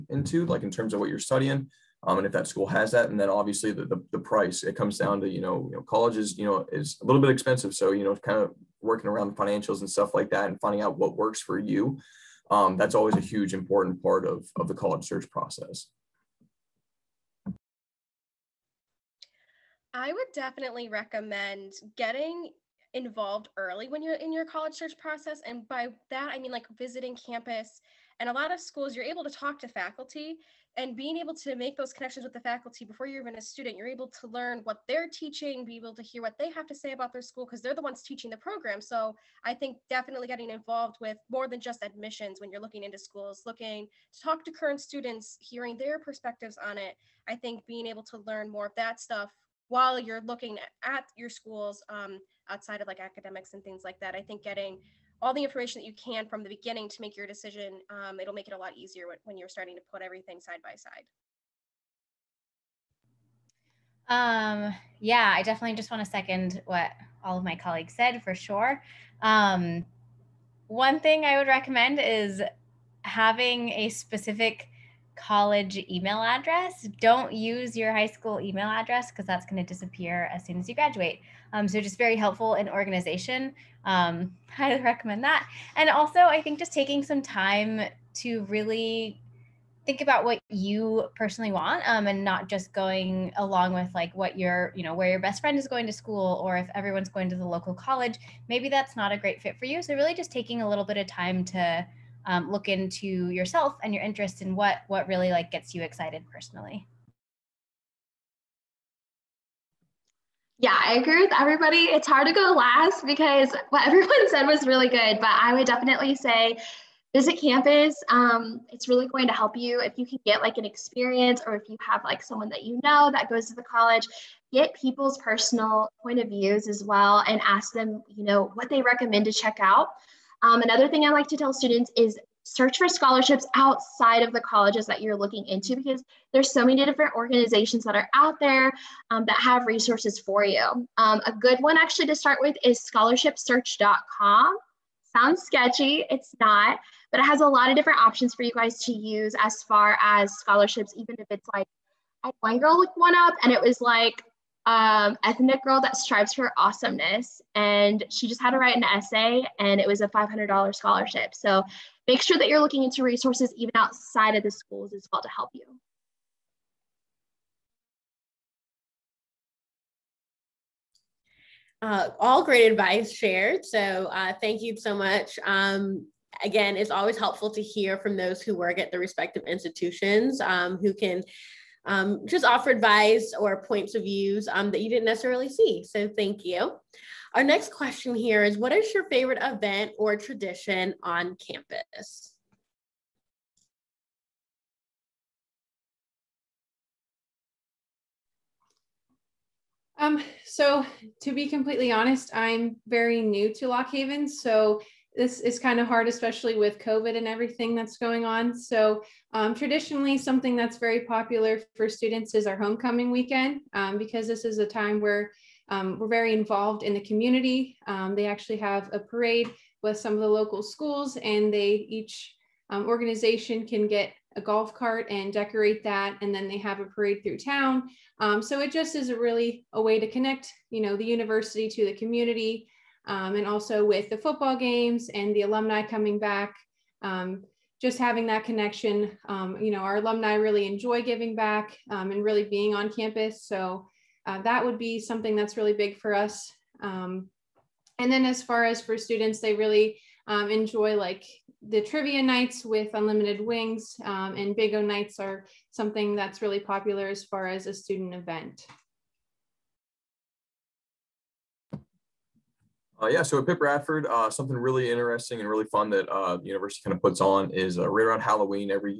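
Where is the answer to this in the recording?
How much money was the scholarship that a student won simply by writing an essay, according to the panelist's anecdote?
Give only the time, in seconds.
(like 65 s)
160 s.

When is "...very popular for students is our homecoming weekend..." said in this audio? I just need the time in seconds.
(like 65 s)
210 s.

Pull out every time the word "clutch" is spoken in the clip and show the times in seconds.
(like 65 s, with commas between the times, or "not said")
not said.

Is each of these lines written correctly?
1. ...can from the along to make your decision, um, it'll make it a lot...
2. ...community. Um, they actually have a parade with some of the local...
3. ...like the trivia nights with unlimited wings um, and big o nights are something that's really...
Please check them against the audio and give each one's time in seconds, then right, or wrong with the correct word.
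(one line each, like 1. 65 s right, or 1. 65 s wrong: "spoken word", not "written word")
1. 55 s wrong: "beginning", not "along"
2. 217 s right
3. 250 s right.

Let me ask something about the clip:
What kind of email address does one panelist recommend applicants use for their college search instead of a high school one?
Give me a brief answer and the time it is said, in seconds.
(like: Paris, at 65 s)
Specific college email address, at 73 s.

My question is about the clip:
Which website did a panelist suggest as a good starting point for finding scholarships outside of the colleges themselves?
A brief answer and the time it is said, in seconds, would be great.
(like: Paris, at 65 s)
scholarshipsearch.com, at 142 s.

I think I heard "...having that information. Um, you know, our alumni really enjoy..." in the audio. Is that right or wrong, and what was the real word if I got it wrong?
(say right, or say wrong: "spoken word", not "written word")
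wrong: "connection", not "information".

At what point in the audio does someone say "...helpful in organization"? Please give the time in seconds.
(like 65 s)
82 s.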